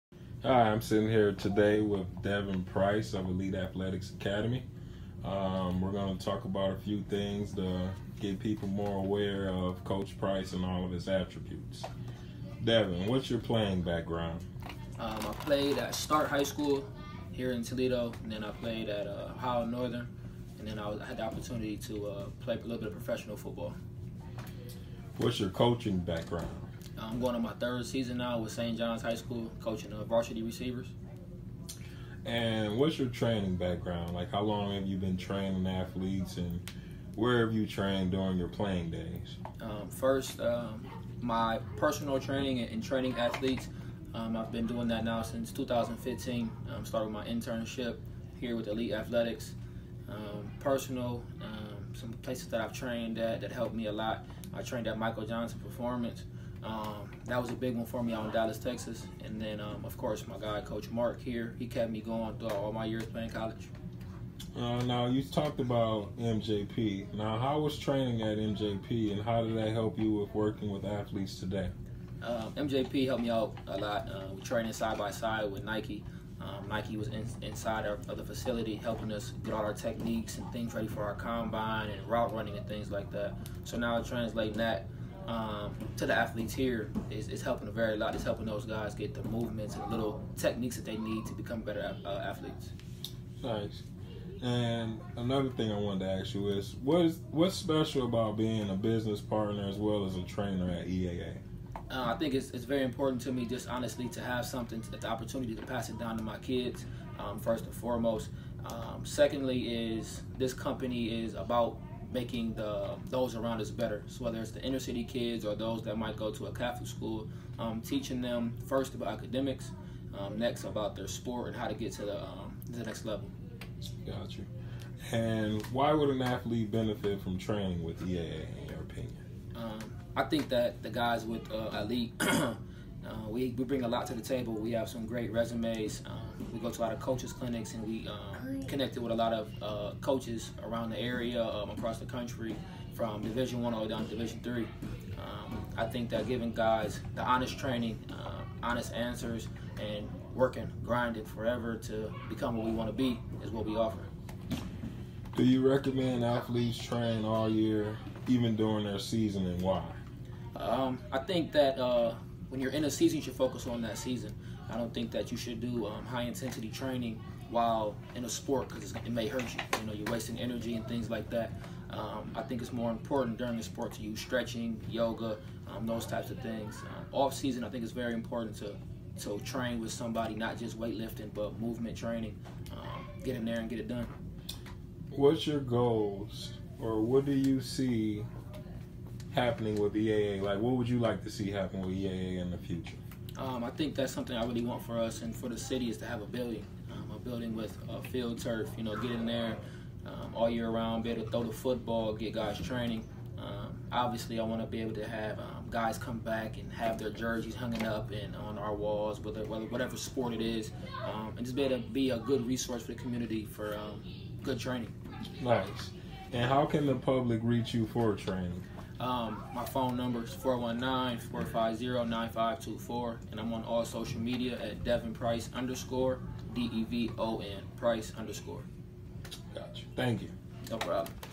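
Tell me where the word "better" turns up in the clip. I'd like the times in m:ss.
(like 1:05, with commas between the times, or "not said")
1:31, 1:53.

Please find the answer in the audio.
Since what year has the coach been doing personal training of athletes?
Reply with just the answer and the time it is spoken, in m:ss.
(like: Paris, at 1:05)
2015, at 0:45.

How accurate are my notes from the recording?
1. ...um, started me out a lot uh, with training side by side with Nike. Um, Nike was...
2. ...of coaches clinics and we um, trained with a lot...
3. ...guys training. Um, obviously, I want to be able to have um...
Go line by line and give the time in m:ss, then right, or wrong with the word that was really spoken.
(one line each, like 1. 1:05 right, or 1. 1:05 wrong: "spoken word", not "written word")
1. 1:13 wrong: "helped", not "started"
2. 2:16 wrong: "connected", not "trained"
3. 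3:22 right.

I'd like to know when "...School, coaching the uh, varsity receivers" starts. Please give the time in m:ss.
0:29.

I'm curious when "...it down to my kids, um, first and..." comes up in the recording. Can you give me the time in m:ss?
1:45.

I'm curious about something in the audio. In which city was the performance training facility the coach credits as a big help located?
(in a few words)
Dallas.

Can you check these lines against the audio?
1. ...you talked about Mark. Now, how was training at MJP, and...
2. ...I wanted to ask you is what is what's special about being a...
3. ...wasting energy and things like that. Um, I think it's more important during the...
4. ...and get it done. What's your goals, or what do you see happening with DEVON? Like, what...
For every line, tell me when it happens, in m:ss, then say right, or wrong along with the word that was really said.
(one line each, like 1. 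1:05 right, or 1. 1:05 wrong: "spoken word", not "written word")
1. 1:05 wrong: "MJP", not "Mark"
2. 1:35 right
3. 2:50 right
4. 3:03 wrong: "EAA", not "DEVON".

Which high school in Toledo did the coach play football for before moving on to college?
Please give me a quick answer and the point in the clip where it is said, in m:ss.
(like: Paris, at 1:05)
Start High School, at 0:15.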